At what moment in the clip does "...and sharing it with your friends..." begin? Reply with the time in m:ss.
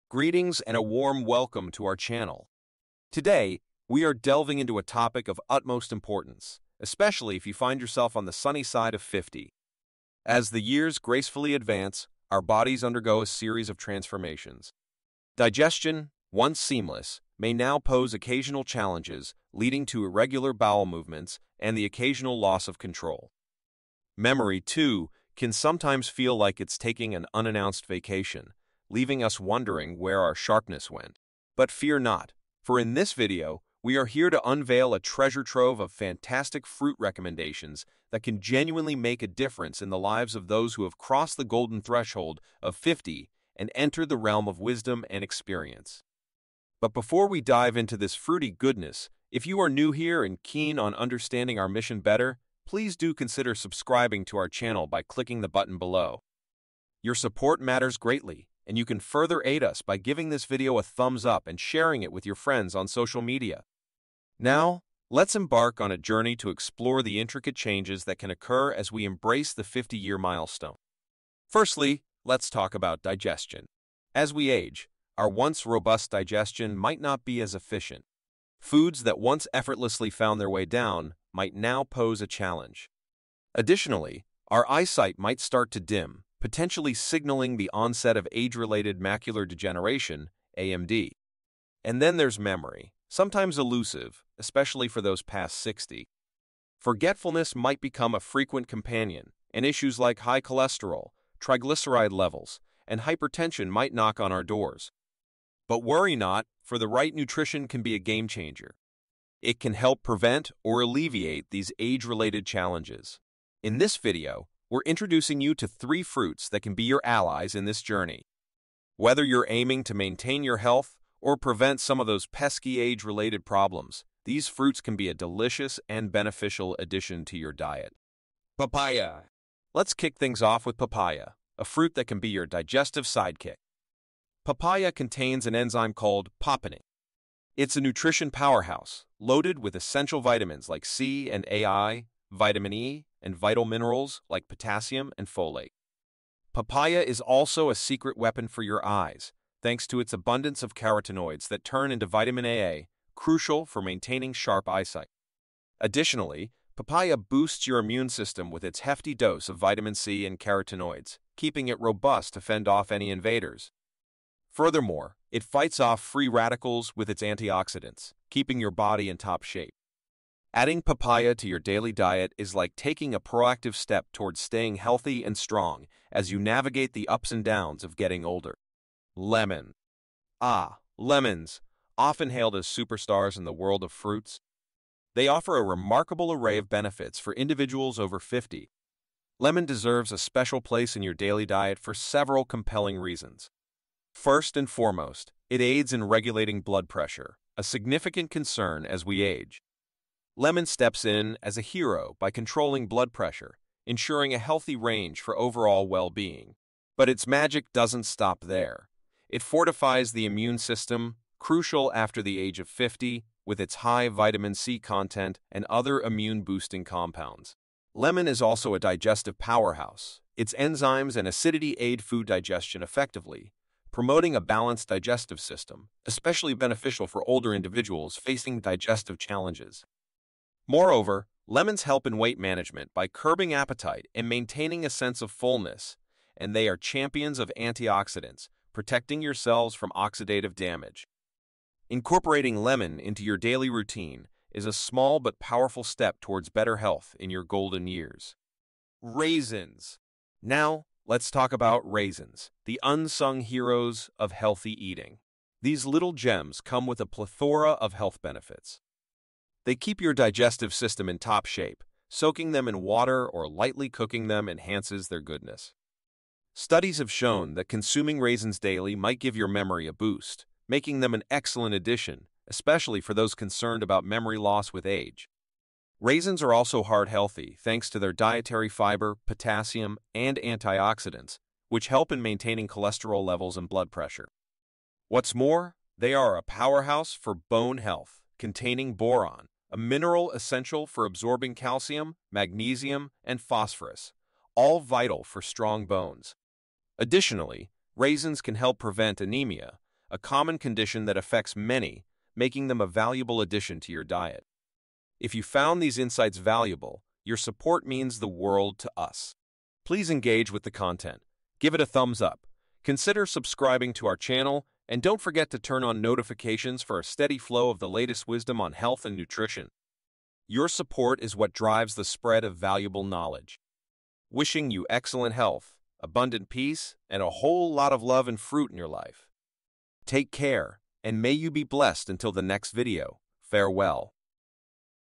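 1:01.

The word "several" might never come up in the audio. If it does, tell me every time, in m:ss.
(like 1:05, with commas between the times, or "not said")
3:11.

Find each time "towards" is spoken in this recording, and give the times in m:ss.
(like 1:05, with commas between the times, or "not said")
2:54, 4:06.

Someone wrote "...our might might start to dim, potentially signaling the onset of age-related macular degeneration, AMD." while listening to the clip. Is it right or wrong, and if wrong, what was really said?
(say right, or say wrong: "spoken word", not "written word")
wrong: "eyesight", not "might".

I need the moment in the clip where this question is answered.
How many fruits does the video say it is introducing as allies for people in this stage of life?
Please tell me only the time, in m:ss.
1:55.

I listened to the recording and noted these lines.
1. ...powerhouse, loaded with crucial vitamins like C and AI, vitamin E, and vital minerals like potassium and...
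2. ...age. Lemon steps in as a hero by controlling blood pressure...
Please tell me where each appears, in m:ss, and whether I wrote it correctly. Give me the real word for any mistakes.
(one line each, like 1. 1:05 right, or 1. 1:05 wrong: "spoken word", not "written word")
1. 2:18 wrong: "essential", not "crucial"
2. 3:19 right.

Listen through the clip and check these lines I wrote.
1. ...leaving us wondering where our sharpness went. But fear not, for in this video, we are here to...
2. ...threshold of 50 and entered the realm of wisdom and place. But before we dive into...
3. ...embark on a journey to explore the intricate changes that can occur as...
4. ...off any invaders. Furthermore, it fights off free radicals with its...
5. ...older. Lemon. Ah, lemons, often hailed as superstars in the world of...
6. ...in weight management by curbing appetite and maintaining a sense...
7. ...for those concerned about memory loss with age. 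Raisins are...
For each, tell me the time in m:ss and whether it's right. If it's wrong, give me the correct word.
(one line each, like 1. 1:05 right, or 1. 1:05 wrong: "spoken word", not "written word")
1. 0:28 right
2. 0:41 wrong: "experience", not "place"
3. 1:05 right
4. 2:42 right
5. 2:58 right
6. 3:52 right
7. 4:33 right.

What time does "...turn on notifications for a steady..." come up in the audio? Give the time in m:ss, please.
5:15.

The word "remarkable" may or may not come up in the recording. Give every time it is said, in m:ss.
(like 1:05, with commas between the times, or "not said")
3:05.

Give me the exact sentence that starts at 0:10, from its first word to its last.
As the years gracefully advance, our bodies undergo a series of transformations.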